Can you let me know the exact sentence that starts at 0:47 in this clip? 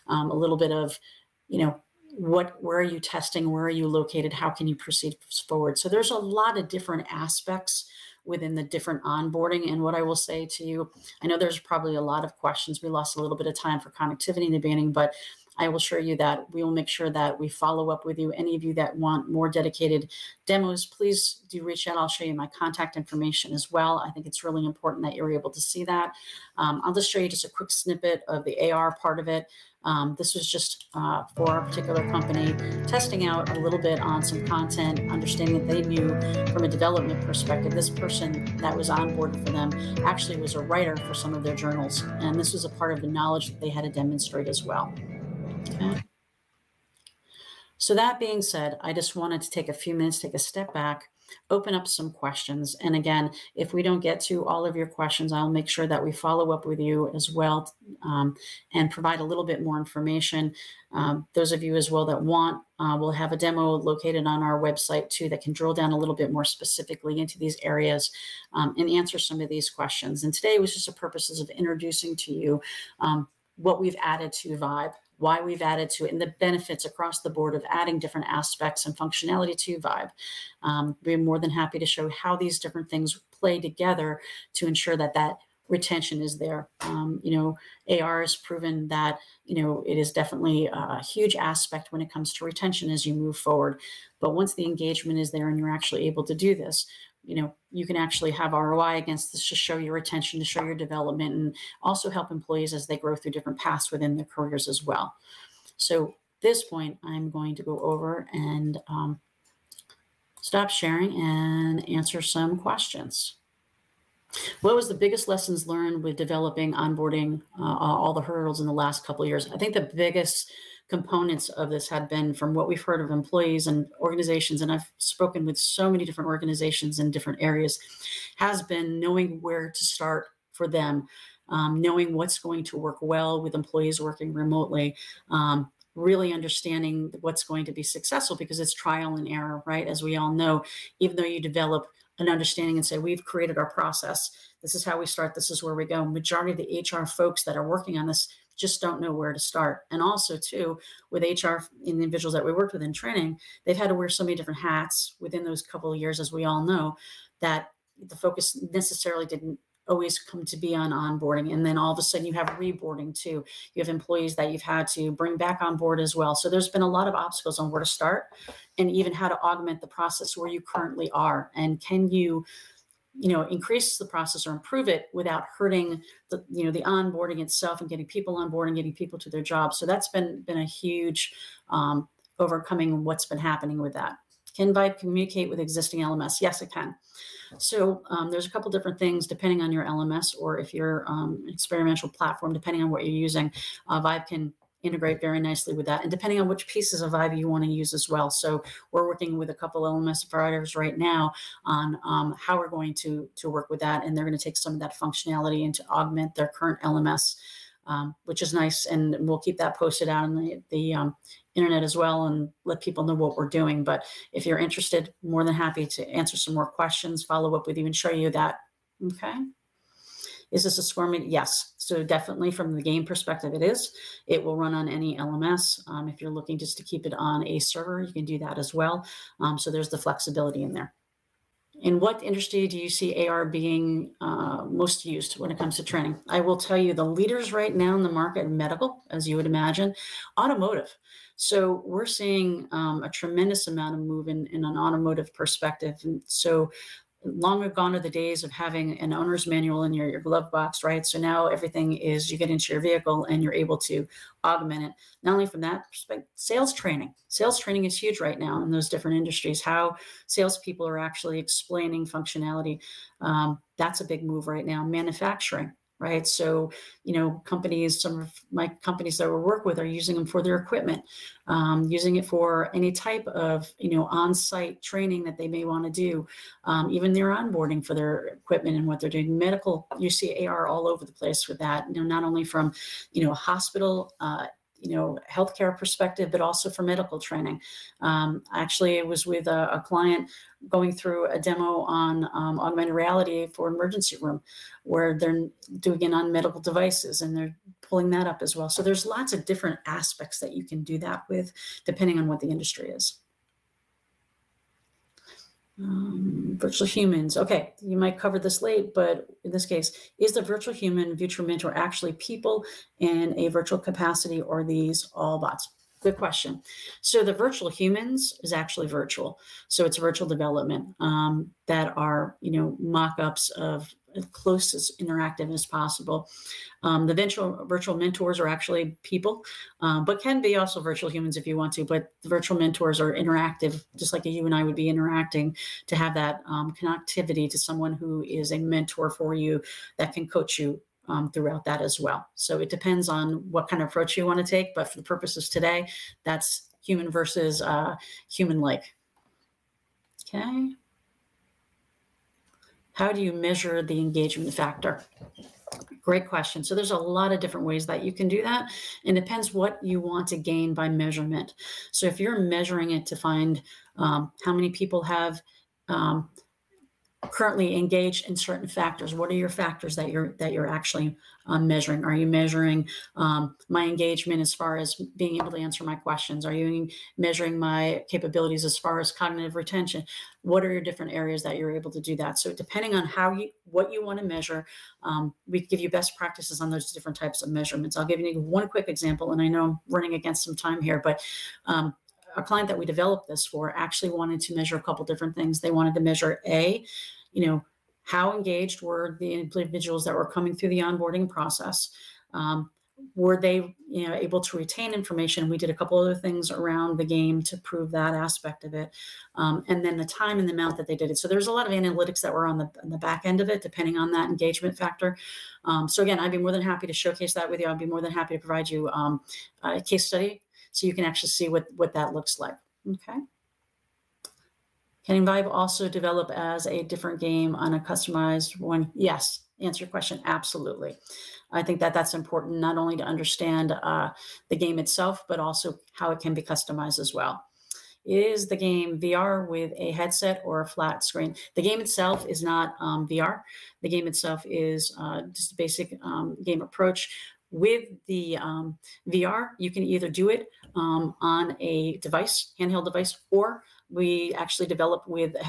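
So, that being said, I just wanted to take a few minutes, take a step back, open up some questions.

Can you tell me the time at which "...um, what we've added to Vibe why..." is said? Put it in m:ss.
1:12.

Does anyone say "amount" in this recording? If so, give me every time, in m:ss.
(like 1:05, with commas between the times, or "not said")
4:03, 6:50.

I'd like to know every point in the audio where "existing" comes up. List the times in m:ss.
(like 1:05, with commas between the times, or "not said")
3:05.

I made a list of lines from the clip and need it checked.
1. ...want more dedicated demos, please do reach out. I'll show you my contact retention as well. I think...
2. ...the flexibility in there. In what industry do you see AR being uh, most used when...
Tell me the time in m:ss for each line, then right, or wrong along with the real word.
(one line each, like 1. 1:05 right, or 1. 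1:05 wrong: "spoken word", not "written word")
1. 0:18 wrong: "information", not "retention"
2. 3:49 right.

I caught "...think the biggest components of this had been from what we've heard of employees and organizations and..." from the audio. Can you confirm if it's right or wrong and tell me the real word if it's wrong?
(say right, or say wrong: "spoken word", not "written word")
right.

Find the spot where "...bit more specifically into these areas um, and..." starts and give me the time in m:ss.
1:06.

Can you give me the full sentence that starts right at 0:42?
And this was a part of the knowledge that they had to demonstrate as well.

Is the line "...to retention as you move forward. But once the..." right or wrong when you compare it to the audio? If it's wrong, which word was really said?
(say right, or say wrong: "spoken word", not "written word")
right.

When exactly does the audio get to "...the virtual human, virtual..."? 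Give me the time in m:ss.
5:10.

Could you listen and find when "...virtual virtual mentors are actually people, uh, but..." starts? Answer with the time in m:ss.
5:27.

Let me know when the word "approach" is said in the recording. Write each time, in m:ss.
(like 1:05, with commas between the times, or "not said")
5:43, 7:26.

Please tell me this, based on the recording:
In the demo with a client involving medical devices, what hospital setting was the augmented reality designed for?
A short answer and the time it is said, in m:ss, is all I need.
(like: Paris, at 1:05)
emergency room, at 4:53.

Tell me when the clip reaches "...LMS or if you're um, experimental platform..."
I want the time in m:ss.
3:09.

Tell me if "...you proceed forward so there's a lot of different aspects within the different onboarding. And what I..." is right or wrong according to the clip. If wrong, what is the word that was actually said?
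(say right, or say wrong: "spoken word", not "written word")
right.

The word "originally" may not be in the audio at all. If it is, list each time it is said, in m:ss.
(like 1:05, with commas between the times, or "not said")
not said.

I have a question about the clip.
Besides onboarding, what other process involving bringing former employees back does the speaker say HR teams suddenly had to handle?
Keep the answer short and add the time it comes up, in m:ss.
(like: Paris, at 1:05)
reboarding, at 2:42.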